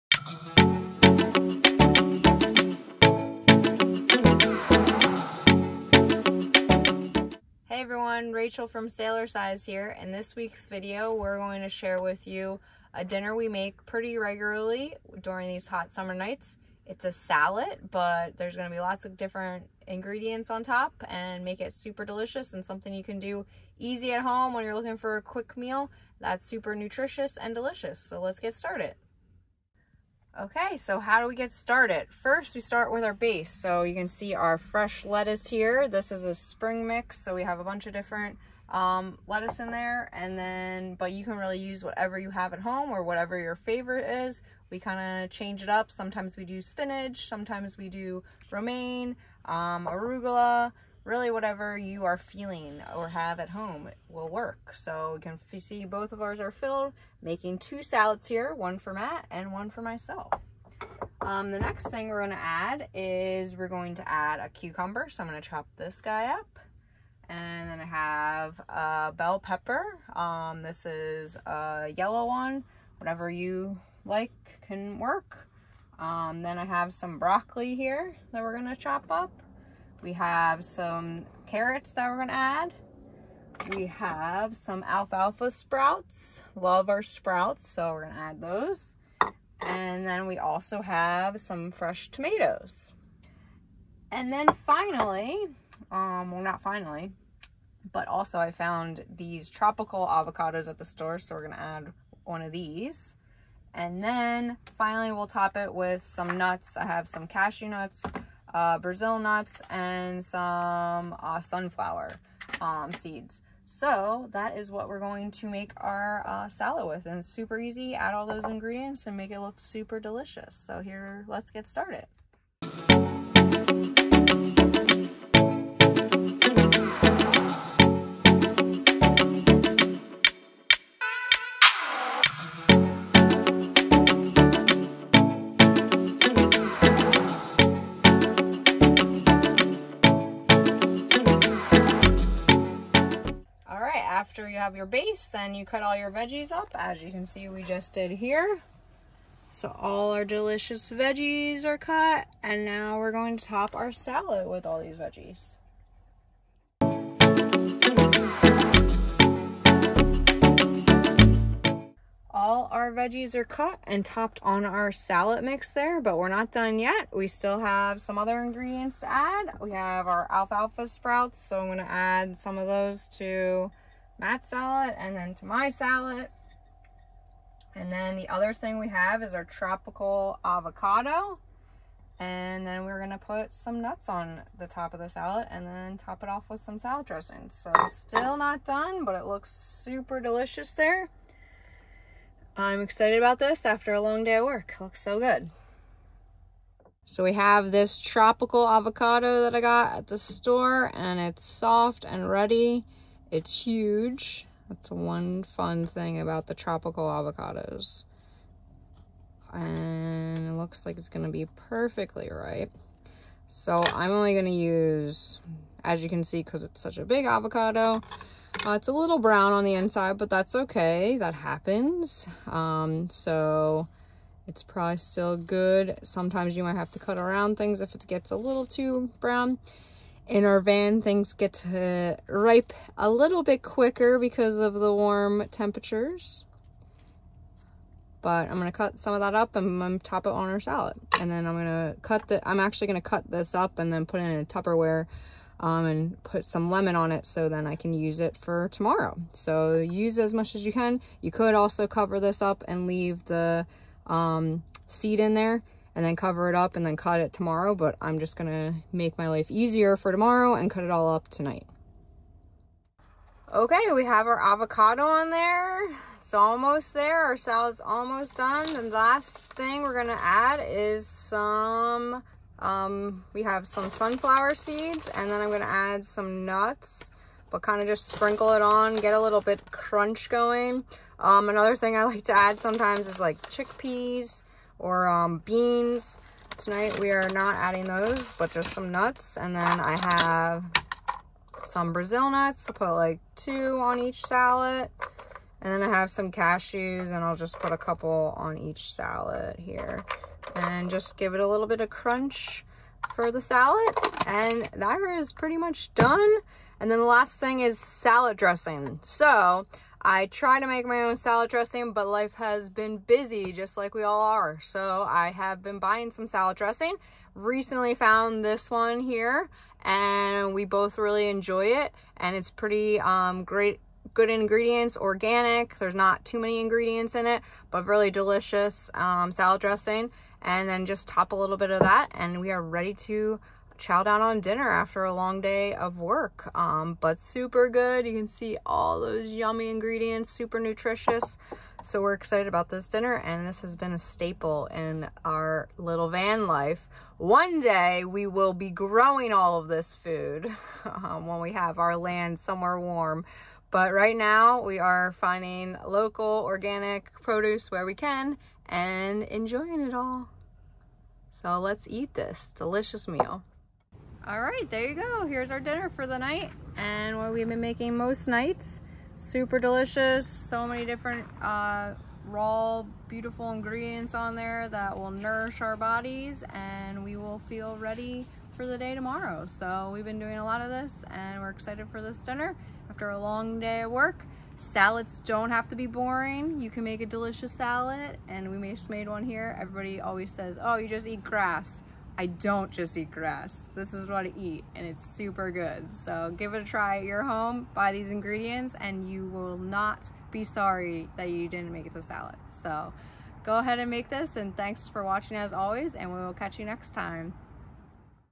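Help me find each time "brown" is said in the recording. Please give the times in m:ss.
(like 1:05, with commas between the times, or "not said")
3:39, 3:49.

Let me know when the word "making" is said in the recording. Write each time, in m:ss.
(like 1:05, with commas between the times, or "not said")
0:57, 6:07.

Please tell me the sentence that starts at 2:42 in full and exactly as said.
All our veggies are cut and topped on our salad mix there, but we're not done yet.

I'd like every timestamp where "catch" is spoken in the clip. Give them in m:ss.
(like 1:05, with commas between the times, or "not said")
6:46.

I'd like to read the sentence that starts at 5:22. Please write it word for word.
And it's pretty um, great good ingredients, organic.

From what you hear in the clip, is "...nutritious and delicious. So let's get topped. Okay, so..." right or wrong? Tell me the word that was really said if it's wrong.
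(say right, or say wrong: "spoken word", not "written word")
wrong: "started", not "topped".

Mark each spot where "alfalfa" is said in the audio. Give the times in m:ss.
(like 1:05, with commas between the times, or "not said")
1:24, 2:50.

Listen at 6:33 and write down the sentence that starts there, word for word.
This is what I eat and it's super good.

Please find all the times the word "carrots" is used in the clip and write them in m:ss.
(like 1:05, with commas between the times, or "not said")
1:21.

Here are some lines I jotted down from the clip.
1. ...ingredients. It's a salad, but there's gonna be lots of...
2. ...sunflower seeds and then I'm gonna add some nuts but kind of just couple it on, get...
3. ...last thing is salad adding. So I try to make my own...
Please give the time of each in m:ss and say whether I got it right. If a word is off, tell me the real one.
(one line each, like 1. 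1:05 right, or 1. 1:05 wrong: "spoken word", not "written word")
1. 0:16 wrong: "nights", not "ingredients"
2. 4:33 wrong: "sprinkle", not "couple"
3. 5:07 wrong: "dressing", not "adding".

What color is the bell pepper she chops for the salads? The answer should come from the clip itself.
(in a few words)
yellow.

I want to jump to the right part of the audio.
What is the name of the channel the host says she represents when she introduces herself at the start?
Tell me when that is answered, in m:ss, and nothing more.
0:08.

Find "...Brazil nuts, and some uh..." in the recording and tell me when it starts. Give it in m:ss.
1:48.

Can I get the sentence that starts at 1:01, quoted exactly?
Um, the next thing we're gonna add is we're going to add a cucumber.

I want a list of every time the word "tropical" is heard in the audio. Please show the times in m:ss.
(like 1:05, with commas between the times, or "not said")
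1:39, 2:59, 3:17, 3:26.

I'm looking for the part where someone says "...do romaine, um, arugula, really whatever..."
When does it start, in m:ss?
0:47.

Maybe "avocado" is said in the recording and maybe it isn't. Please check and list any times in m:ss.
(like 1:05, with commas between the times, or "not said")
1:40, 3:00, 3:18, 3:27, 3:37, 4:24.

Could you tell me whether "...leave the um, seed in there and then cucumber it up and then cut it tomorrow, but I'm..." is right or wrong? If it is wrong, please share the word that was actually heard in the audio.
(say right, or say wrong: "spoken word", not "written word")
wrong: "cover", not "cucumber".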